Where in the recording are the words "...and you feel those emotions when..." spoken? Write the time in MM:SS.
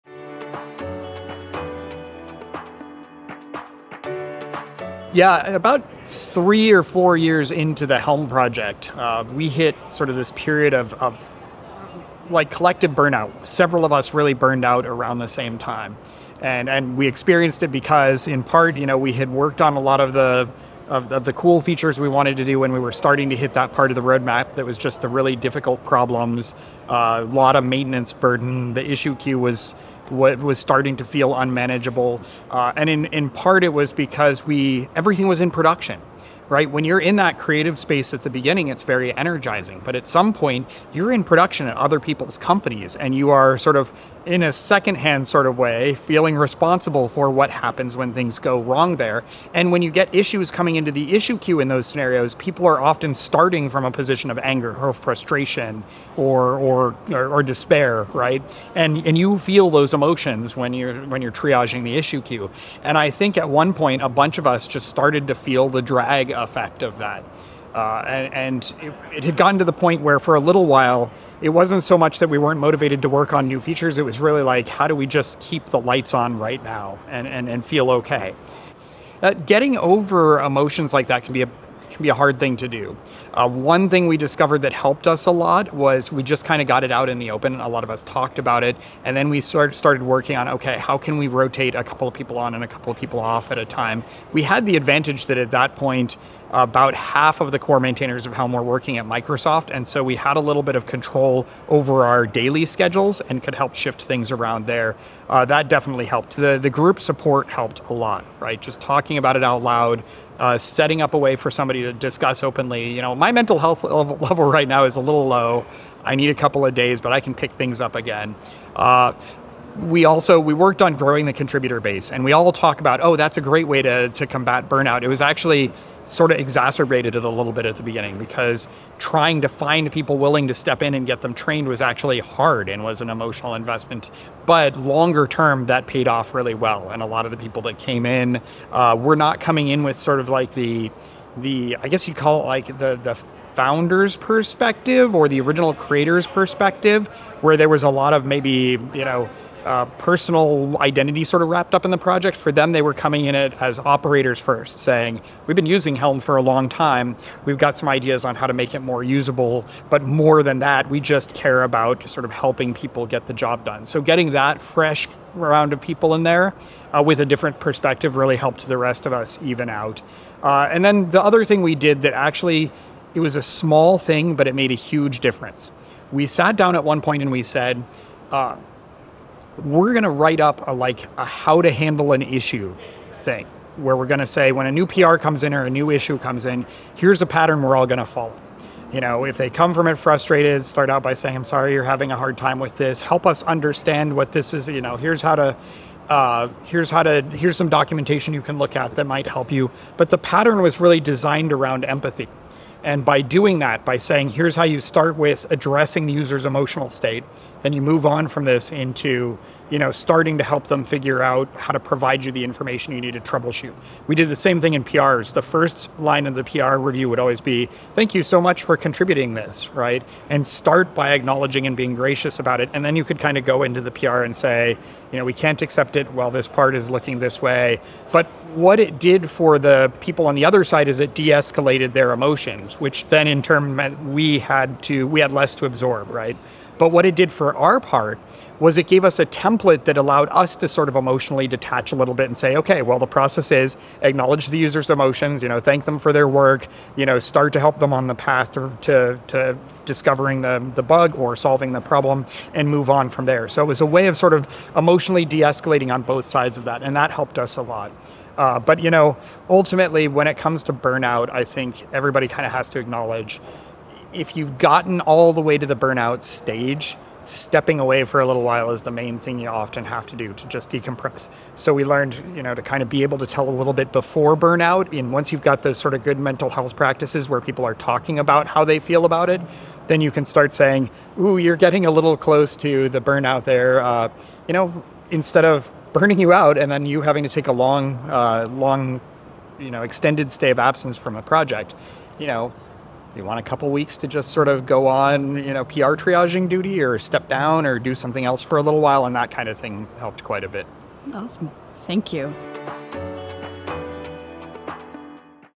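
00:59.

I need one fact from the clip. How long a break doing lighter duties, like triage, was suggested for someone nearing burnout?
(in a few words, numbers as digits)
A couple weeks.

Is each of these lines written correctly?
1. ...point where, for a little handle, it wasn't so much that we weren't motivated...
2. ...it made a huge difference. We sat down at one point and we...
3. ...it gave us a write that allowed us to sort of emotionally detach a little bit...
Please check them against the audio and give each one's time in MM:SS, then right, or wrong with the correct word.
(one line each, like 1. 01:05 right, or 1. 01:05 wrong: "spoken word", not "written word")
1. 01:09 wrong: "while", not "handle"
2. 02:54 right
3. 03:58 wrong: "template", not "write".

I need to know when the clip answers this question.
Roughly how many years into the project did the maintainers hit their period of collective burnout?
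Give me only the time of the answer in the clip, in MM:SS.
00:06.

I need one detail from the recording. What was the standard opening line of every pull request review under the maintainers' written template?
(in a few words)
Thank you so much for contributing this.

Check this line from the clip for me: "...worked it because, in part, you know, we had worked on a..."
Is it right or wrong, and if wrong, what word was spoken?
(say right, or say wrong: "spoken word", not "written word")
wrong: "experienced", not "worked".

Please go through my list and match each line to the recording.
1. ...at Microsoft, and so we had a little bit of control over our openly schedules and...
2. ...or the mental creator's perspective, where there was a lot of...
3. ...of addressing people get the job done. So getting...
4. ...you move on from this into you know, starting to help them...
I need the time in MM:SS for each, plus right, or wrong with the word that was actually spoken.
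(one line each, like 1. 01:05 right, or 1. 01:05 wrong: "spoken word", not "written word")
1. 01:38 wrong: "daily", not "openly"
2. 02:25 wrong: "original", not "mental"
3. 02:42 wrong: "helping", not "addressing"
4. 03:27 right.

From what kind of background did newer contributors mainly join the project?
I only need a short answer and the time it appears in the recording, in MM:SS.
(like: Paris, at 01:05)
Operators, at 02:33.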